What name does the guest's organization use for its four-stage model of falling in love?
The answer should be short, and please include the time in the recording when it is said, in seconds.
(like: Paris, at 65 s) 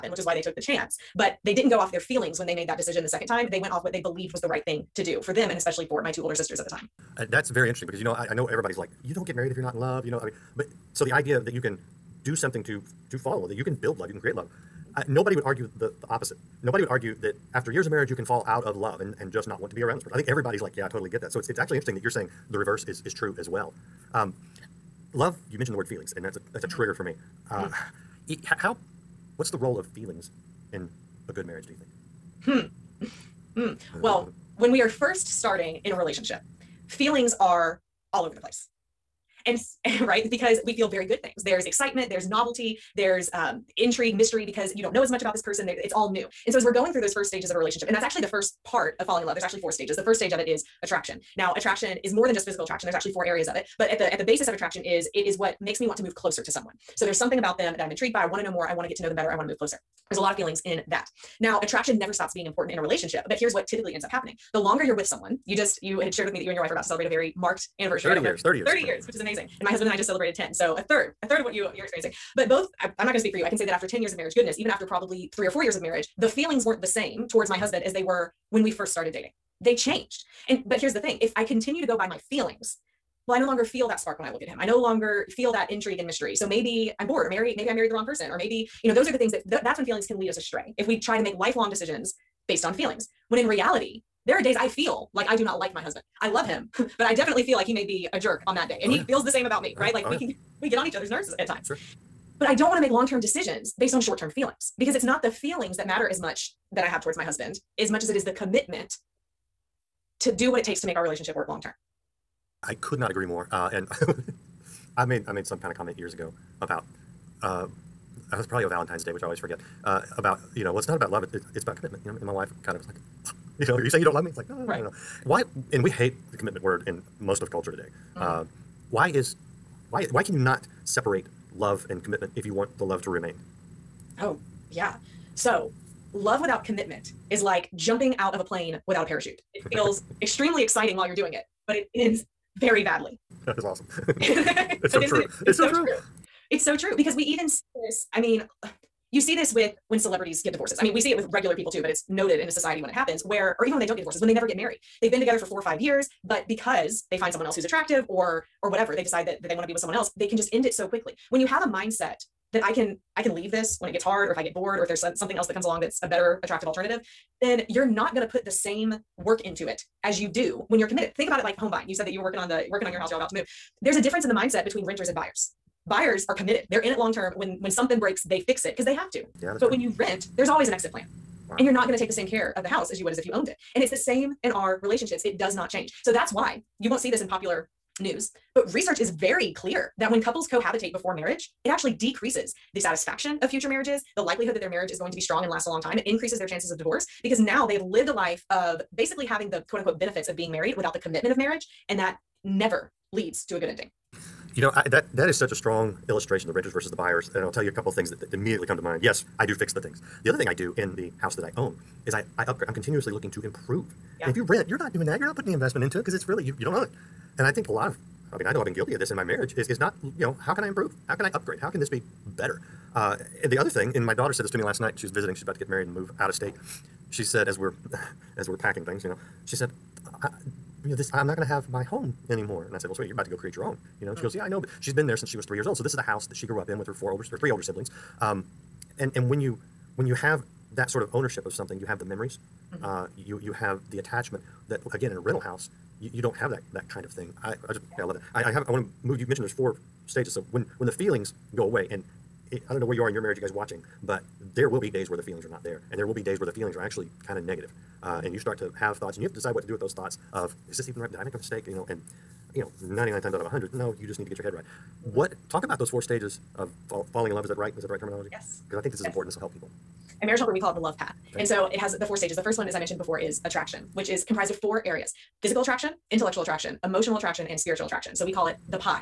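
The love path, at 270 s.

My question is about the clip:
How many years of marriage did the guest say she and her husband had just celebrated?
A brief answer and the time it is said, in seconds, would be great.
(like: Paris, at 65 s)
10, at 69 s.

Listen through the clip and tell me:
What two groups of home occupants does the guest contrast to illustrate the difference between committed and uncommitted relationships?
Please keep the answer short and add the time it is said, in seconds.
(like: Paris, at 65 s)
Renters and buyers, at 174 s.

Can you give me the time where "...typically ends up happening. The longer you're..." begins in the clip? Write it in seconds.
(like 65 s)
63 s.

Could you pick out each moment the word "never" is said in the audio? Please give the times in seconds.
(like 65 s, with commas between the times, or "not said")
61 s, 154 s, 202 s.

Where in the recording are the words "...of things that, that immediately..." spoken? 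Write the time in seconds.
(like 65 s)
207 s.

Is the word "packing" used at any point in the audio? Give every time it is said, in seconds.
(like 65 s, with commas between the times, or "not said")
228 s.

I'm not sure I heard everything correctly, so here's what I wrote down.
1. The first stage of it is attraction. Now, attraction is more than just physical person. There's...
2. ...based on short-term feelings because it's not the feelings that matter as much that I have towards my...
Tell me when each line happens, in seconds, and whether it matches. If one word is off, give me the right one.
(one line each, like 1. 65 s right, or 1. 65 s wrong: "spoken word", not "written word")
1. 49 s wrong: "attraction", not "person"
2. 103 s right.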